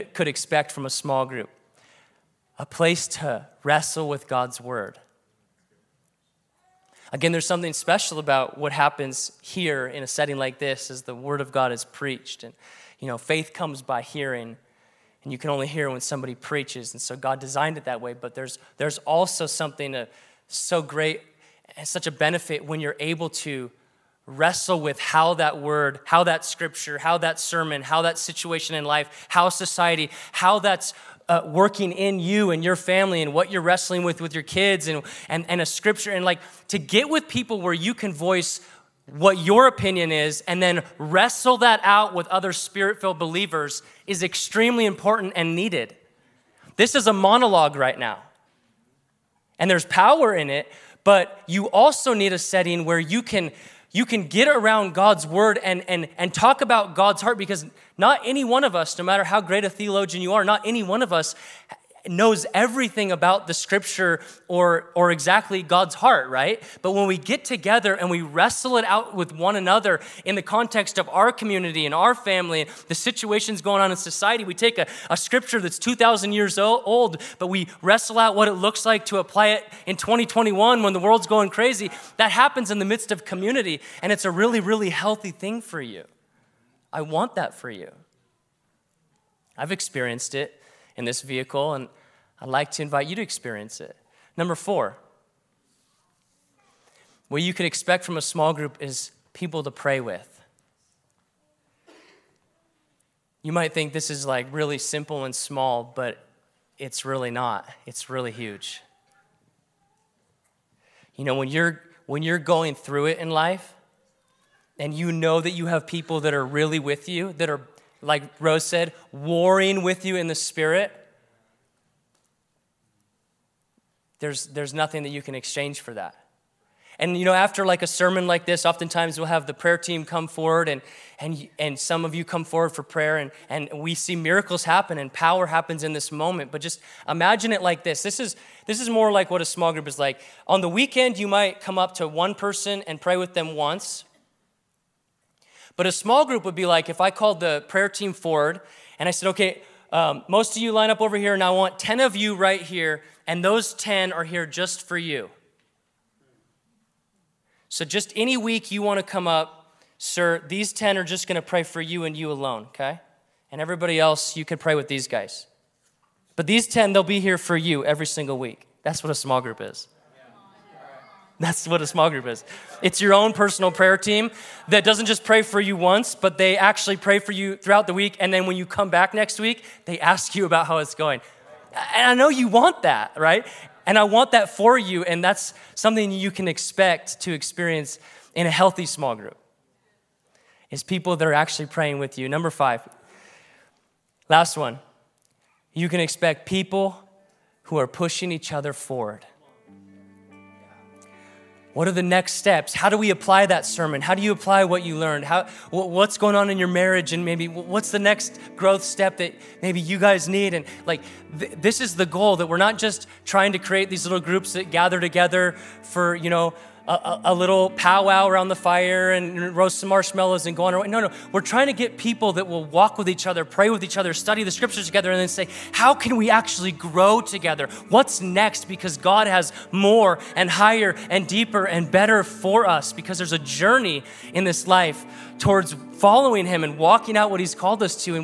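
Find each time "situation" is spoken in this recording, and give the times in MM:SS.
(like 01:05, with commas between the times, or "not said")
00:28, 01:12.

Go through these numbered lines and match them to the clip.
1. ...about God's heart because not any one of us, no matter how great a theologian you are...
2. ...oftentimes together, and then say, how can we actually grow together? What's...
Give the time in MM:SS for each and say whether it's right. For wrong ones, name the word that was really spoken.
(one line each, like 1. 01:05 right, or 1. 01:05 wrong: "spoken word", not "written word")
1. 00:56 right
2. 03:44 wrong: "scriptures", not "oftentimes".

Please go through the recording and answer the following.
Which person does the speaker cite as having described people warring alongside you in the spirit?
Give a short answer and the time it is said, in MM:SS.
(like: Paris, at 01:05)
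Rose, at 01:58.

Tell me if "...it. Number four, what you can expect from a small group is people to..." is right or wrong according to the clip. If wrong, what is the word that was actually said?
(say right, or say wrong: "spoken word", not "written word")
right.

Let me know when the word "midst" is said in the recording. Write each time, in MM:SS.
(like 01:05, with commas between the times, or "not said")
01:22.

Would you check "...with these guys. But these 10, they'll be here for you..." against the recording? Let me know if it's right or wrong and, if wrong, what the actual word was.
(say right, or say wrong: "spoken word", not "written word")
right.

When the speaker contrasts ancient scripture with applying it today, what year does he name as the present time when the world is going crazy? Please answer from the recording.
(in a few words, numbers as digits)
2021.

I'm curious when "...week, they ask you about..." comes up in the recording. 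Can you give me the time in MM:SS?
02:59.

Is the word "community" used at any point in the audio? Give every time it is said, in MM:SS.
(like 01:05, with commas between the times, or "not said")
01:11, 01:23.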